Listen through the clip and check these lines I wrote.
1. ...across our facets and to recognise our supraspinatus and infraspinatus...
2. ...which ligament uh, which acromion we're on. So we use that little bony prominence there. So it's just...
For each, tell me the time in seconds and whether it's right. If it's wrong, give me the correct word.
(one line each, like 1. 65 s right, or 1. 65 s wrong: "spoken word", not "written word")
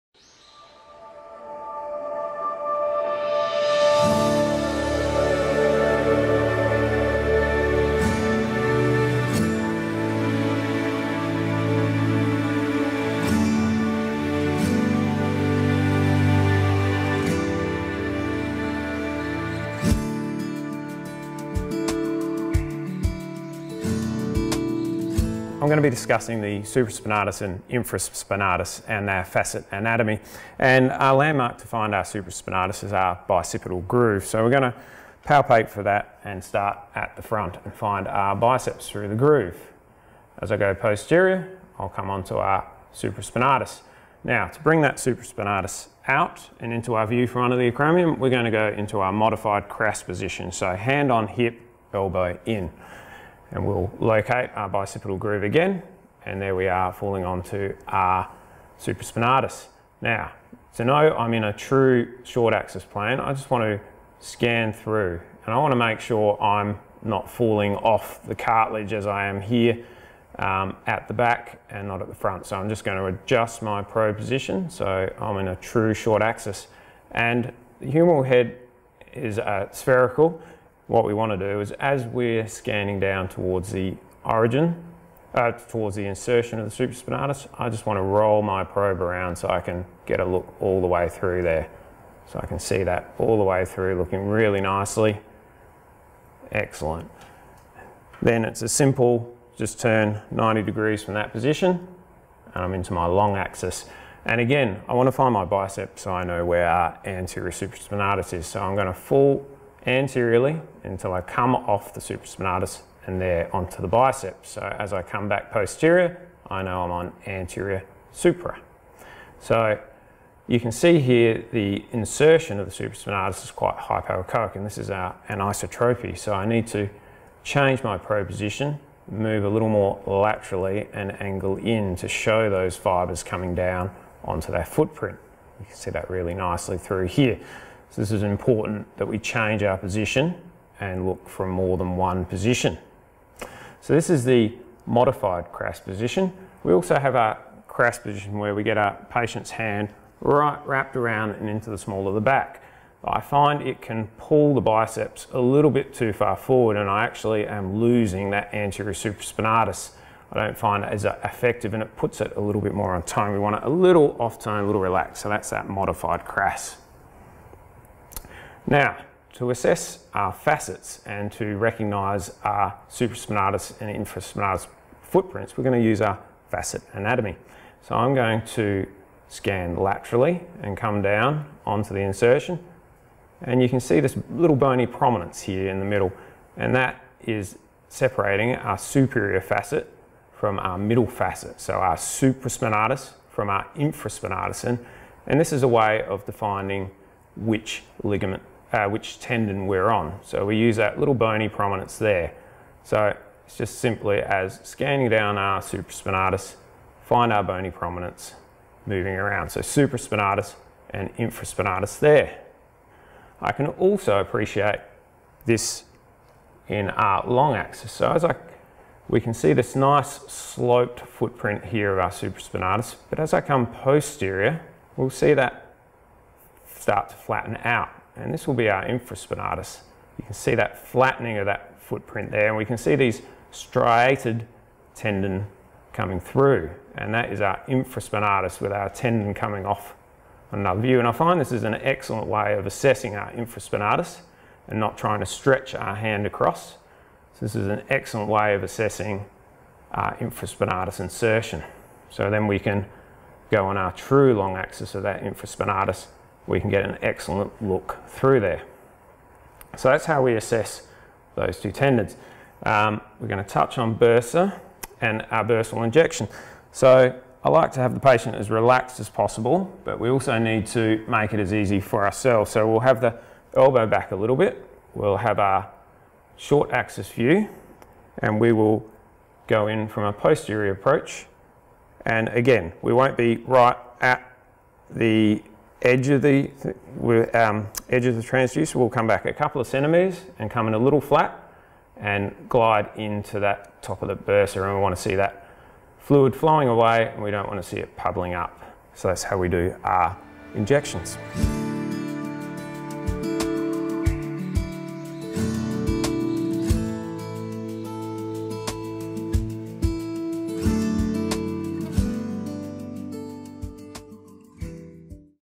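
1. 169 s wrong: "assess", not "across"
2. 197 s wrong: "tendon", not "acromion".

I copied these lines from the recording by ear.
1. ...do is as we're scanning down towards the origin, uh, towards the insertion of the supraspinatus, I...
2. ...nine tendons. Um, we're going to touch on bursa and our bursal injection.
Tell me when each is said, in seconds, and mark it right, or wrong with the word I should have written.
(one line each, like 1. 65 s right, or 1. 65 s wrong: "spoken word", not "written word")
1. 81 s right
2. 261 s wrong: "two", not "nine".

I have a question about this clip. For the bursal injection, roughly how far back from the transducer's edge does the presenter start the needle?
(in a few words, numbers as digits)
A couple of centimetres.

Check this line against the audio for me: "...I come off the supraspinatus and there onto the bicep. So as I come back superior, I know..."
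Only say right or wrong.
wrong.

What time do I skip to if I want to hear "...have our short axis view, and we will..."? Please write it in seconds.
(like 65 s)
275 s.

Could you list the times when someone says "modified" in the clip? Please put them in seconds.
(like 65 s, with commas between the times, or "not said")
49 s, 144 s, 165 s.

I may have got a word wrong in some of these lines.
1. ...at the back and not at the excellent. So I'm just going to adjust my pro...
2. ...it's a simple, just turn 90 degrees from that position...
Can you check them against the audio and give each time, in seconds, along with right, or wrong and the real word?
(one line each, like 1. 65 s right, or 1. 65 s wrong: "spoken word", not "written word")
1. 70 s wrong: "front", not "excellent"
2. 98 s right.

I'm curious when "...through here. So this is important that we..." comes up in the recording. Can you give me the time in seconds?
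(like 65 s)
136 s.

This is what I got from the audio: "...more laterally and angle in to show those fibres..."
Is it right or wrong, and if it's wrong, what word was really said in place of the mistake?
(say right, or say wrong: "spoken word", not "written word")
right.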